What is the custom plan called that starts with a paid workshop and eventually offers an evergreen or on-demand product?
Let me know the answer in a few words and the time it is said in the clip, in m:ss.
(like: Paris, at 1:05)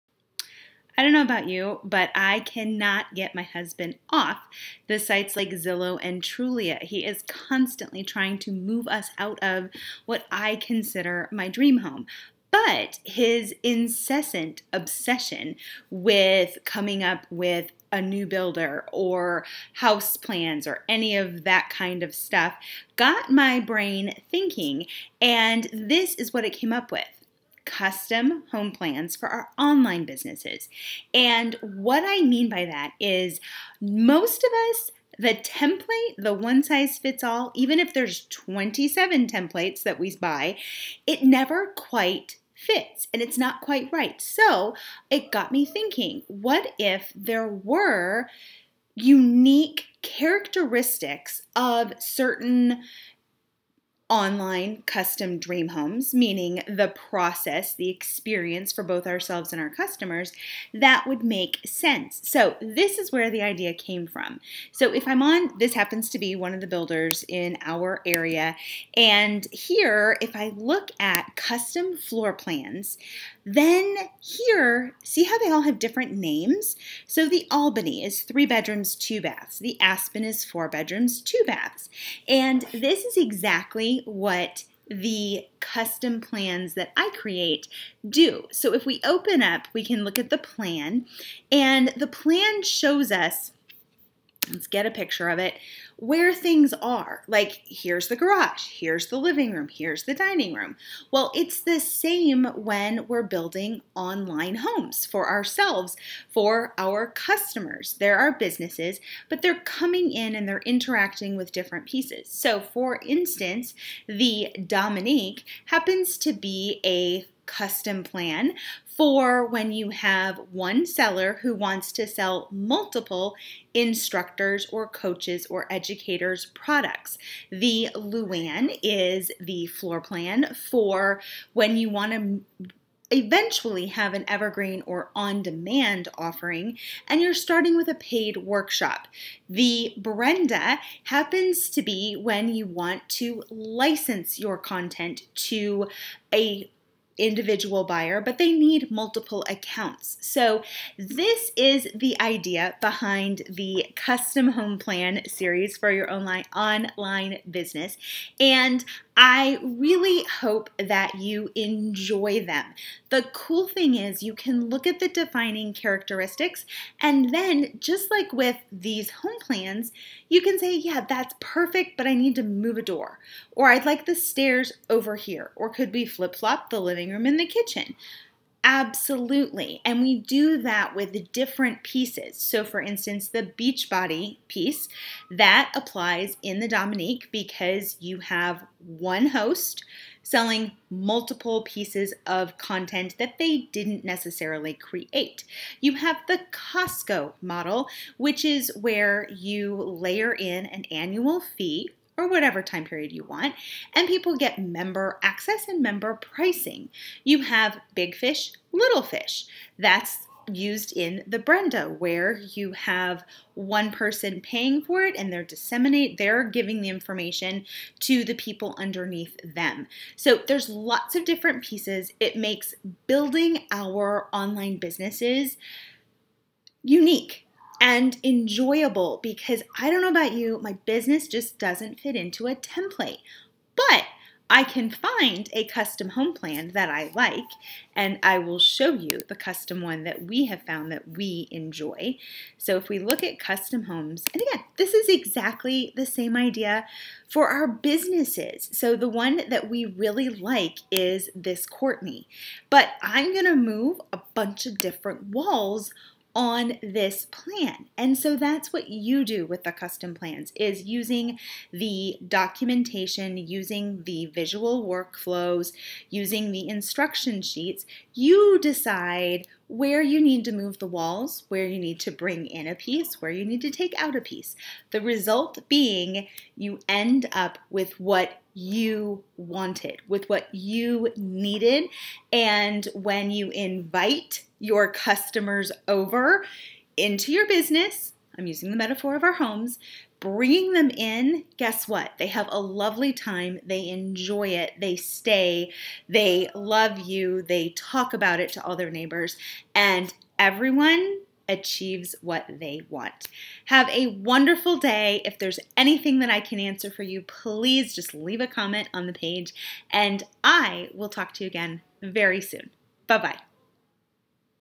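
Luan, at 2:07.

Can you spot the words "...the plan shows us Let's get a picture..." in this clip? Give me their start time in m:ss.
1:31.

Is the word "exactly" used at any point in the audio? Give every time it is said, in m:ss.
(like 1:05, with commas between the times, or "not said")
1:23, 4:05.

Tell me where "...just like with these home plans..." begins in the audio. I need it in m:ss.
2:47.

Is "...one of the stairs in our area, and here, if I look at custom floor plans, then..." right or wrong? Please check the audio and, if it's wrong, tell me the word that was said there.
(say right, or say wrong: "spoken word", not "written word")
wrong: "builders", not "stairs".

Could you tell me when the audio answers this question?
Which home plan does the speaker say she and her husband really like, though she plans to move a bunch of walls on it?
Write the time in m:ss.
4:11.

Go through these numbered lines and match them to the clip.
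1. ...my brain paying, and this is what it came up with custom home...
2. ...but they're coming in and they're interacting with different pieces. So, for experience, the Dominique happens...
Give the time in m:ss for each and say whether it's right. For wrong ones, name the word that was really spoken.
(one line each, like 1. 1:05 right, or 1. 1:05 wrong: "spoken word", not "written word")
1. 0:23 wrong: "thinking", not "paying"
2. 1:49 wrong: "instance", not "experience".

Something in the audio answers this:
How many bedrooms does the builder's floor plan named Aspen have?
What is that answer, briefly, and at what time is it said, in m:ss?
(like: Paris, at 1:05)
4, at 1:20.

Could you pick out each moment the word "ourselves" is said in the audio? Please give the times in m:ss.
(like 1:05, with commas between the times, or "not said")
0:59, 1:45.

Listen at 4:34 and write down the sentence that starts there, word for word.
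The result being you end up with what you wanted, with what you needed.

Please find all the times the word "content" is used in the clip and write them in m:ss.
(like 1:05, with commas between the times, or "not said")
2:24, 3:12.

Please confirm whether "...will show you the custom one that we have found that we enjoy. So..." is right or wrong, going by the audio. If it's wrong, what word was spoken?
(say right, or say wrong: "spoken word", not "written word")
right.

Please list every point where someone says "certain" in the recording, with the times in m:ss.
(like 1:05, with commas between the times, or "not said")
0:51.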